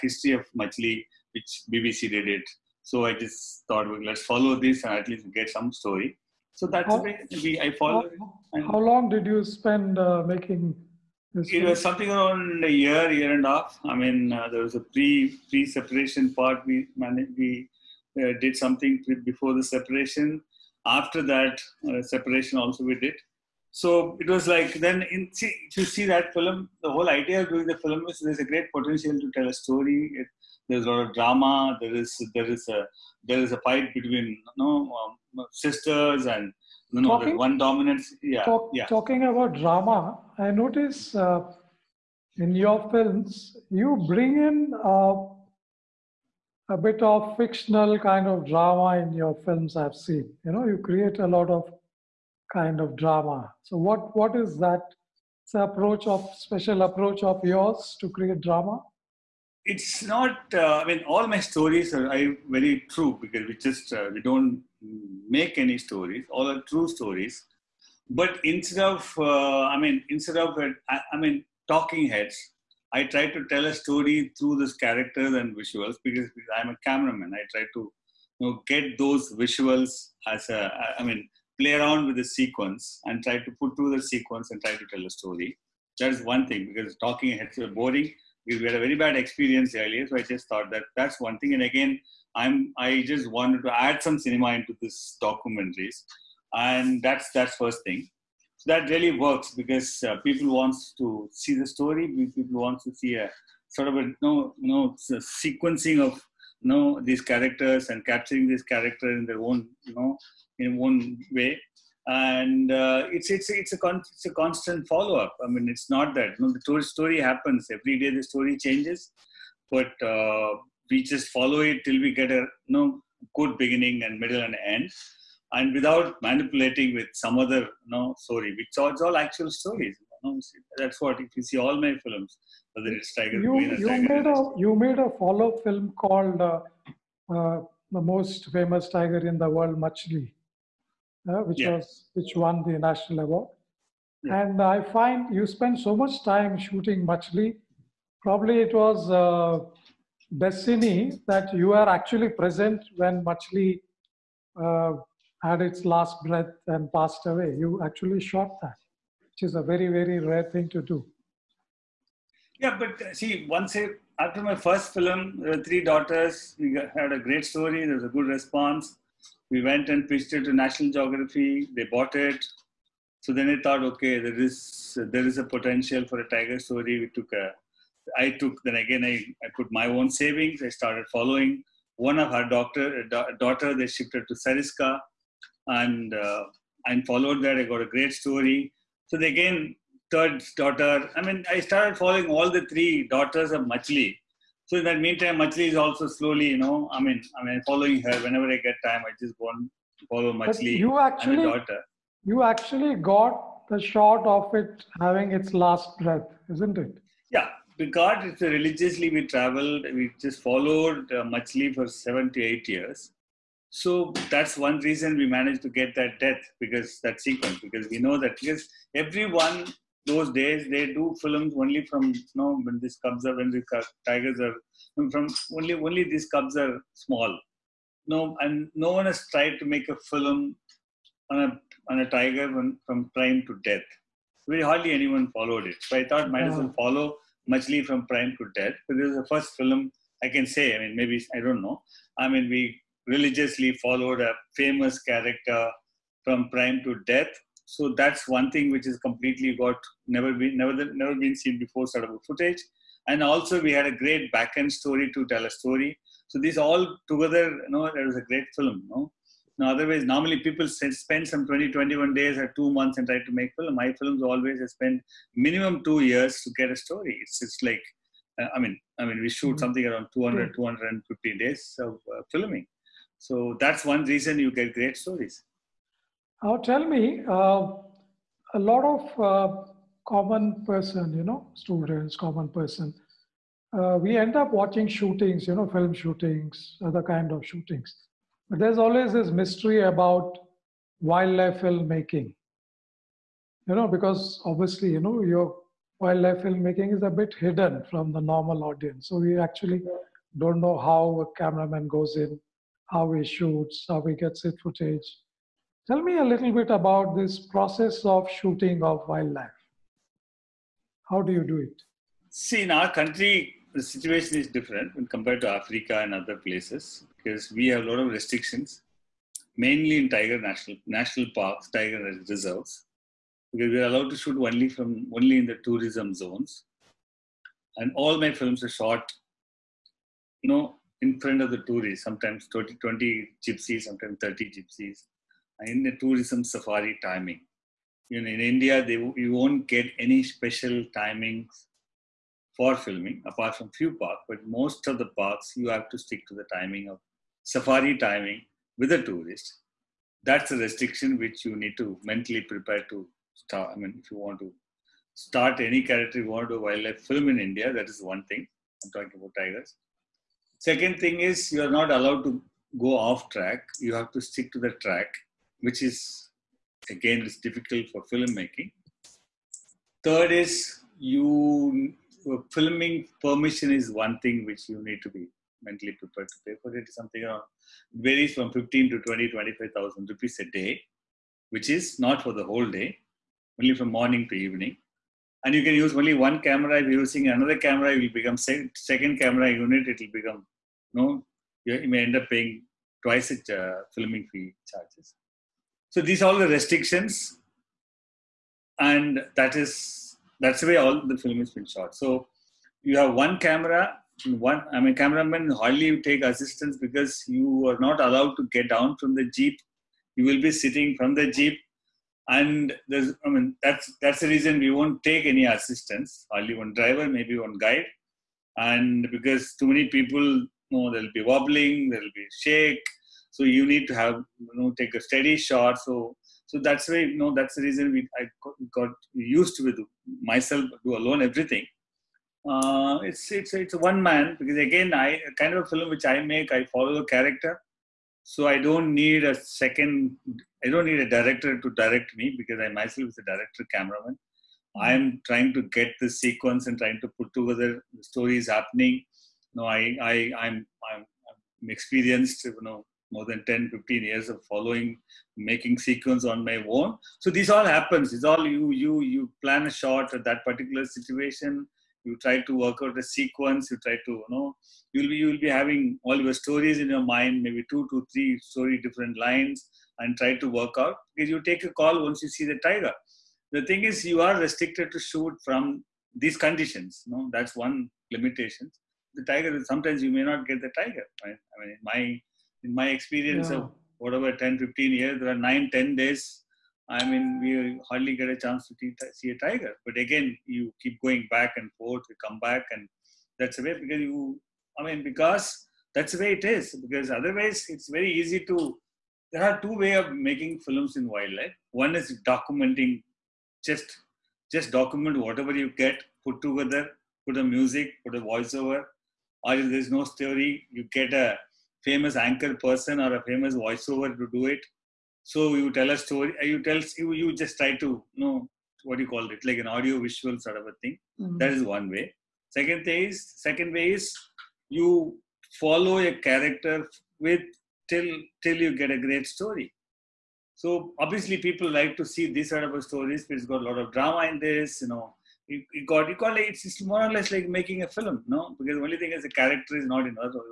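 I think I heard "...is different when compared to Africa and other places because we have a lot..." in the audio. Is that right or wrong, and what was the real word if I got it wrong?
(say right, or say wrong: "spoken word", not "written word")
right.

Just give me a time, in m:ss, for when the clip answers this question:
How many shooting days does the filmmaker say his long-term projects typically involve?
4:30.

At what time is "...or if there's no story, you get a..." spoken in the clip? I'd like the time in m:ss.
8:29.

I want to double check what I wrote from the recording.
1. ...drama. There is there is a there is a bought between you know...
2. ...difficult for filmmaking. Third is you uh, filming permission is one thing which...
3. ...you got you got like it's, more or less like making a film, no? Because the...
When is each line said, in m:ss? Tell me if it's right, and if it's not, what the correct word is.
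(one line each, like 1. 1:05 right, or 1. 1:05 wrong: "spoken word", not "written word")
1. 0:31 wrong: "fight", not "bought"
2. 6:07 right
3. 8:55 right.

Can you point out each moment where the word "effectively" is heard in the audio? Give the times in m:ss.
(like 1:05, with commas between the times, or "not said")
not said.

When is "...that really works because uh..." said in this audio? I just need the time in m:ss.
1:38.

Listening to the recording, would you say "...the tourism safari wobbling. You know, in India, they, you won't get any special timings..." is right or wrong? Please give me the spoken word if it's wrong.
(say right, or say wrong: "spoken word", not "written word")
wrong: "timing", not "wobbling".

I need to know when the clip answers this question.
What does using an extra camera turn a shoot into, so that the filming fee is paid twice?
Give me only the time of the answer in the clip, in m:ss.
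6:28.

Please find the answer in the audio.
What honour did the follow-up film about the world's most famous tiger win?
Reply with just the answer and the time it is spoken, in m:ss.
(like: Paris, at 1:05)
national award, at 2:22.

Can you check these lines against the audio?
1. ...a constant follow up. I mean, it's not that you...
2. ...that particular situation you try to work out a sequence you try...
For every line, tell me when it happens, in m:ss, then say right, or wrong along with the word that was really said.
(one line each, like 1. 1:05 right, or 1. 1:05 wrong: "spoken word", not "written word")
1. 1:54 right
2. 7:40 right.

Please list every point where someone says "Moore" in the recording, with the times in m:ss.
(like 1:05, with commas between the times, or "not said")
not said.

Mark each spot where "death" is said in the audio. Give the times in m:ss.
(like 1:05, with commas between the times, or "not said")
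3:36, 3:53, 3:58, 4:07.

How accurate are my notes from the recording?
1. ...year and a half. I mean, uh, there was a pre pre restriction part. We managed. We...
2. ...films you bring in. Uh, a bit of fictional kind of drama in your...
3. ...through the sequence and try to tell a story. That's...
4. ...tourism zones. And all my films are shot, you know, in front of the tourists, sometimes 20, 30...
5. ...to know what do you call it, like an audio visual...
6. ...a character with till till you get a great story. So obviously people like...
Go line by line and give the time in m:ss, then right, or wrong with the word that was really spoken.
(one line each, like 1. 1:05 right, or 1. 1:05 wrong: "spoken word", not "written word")
1. 0:13 wrong: "separation", not "restriction"
2. 0:42 right
3. 1:23 right
4. 5:25 wrong: "20", not "30"
5. 8:37 right
6. 8:45 right.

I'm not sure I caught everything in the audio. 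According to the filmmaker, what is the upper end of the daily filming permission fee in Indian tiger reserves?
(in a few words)
25,000 rupees.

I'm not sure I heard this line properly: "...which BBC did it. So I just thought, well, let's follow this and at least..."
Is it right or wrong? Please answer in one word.
right.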